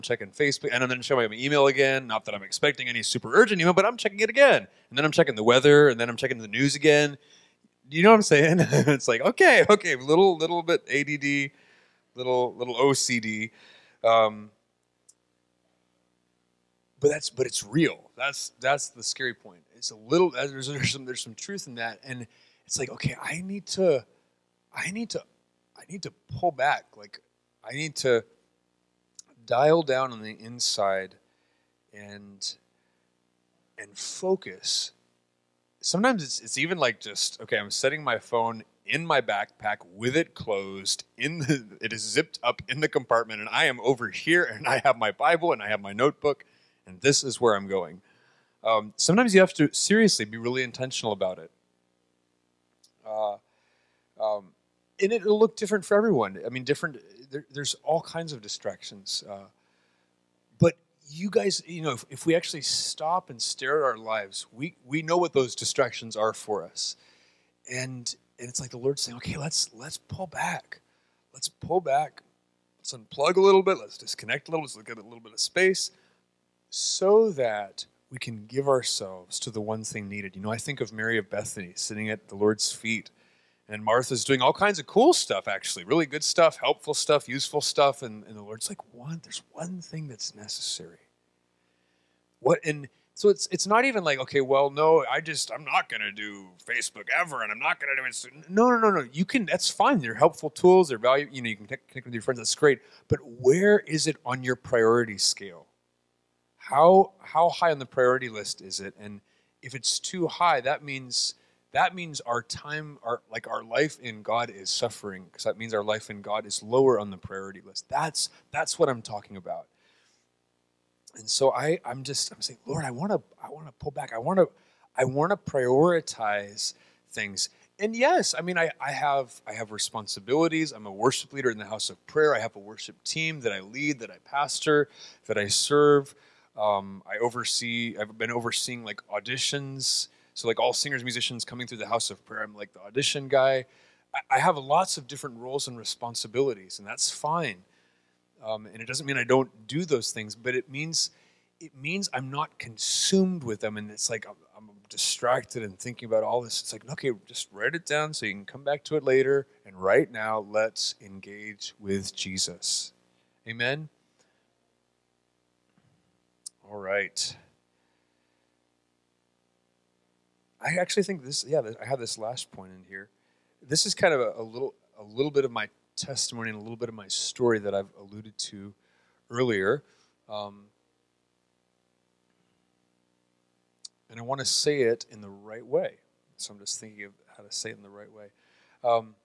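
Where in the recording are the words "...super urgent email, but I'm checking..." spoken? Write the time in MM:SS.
00:03.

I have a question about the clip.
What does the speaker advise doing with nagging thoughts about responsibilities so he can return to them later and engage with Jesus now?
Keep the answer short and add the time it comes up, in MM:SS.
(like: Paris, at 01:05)
Write it down, at 02:37.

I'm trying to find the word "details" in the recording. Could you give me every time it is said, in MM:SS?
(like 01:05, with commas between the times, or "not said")
not said.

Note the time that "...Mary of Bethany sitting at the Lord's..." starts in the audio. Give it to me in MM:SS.
01:20.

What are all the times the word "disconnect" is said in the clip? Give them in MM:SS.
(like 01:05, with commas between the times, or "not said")
01:13.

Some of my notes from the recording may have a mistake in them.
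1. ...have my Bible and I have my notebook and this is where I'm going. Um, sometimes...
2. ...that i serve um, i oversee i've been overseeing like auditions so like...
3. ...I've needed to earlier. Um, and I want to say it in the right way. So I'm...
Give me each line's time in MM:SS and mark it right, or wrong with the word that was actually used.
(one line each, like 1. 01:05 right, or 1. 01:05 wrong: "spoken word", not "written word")
1. 00:44 right
2. 02:15 right
3. 02:57 wrong: "alluded", not "needed".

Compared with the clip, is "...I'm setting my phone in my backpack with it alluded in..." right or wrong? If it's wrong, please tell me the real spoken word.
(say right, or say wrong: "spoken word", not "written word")
wrong: "closed", not "alluded".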